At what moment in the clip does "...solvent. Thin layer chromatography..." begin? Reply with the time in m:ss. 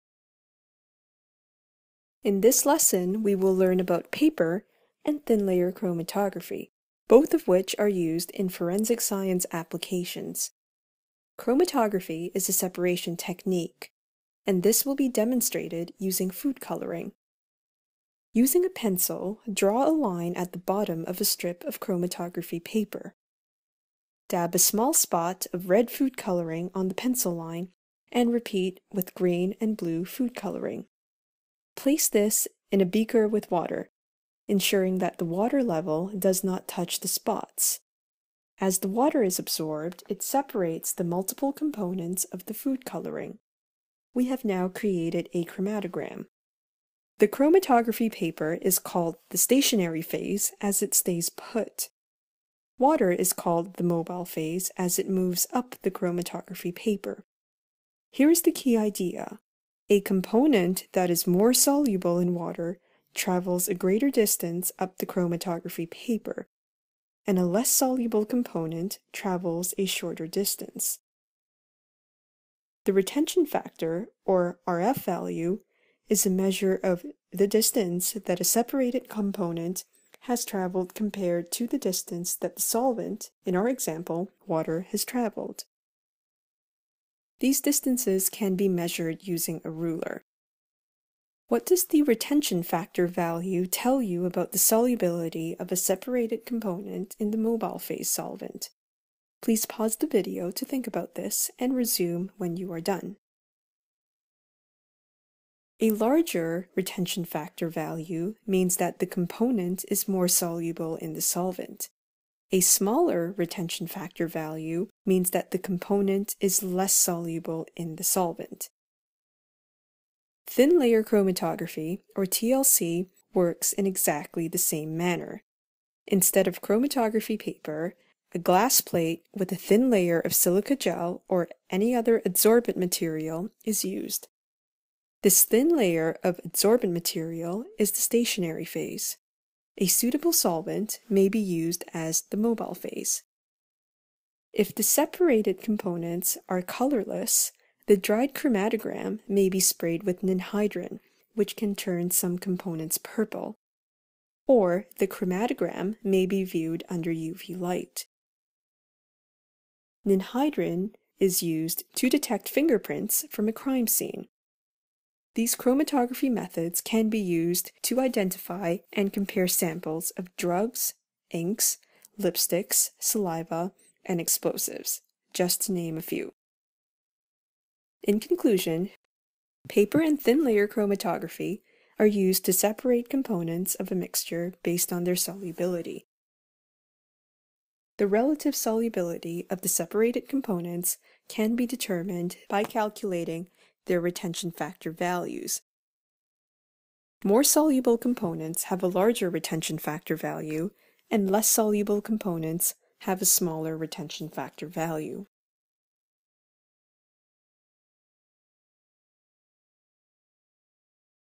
1:58.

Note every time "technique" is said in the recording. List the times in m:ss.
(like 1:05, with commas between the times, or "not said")
0:13.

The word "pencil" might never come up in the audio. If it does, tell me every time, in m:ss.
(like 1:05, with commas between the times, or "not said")
0:18, 0:26.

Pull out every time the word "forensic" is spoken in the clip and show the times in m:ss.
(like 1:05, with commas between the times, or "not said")
0:08.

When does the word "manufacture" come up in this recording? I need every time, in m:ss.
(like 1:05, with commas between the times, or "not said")
not said.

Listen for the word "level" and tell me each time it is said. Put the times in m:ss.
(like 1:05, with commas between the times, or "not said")
0:35.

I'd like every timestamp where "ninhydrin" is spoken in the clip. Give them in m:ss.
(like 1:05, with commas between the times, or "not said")
2:30, 2:40.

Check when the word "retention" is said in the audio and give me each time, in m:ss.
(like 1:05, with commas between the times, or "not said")
1:12, 1:32, 1:46, 1:53, 3:14, 3:19, 3:23.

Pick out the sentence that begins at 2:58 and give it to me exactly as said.
In conclusion, paper and thin layer chromatography are used to separate components of a mixture based on their solubility.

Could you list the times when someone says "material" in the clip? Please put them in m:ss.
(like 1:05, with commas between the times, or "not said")
2:12, 2:16.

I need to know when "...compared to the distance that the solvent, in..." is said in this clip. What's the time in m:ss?
1:20.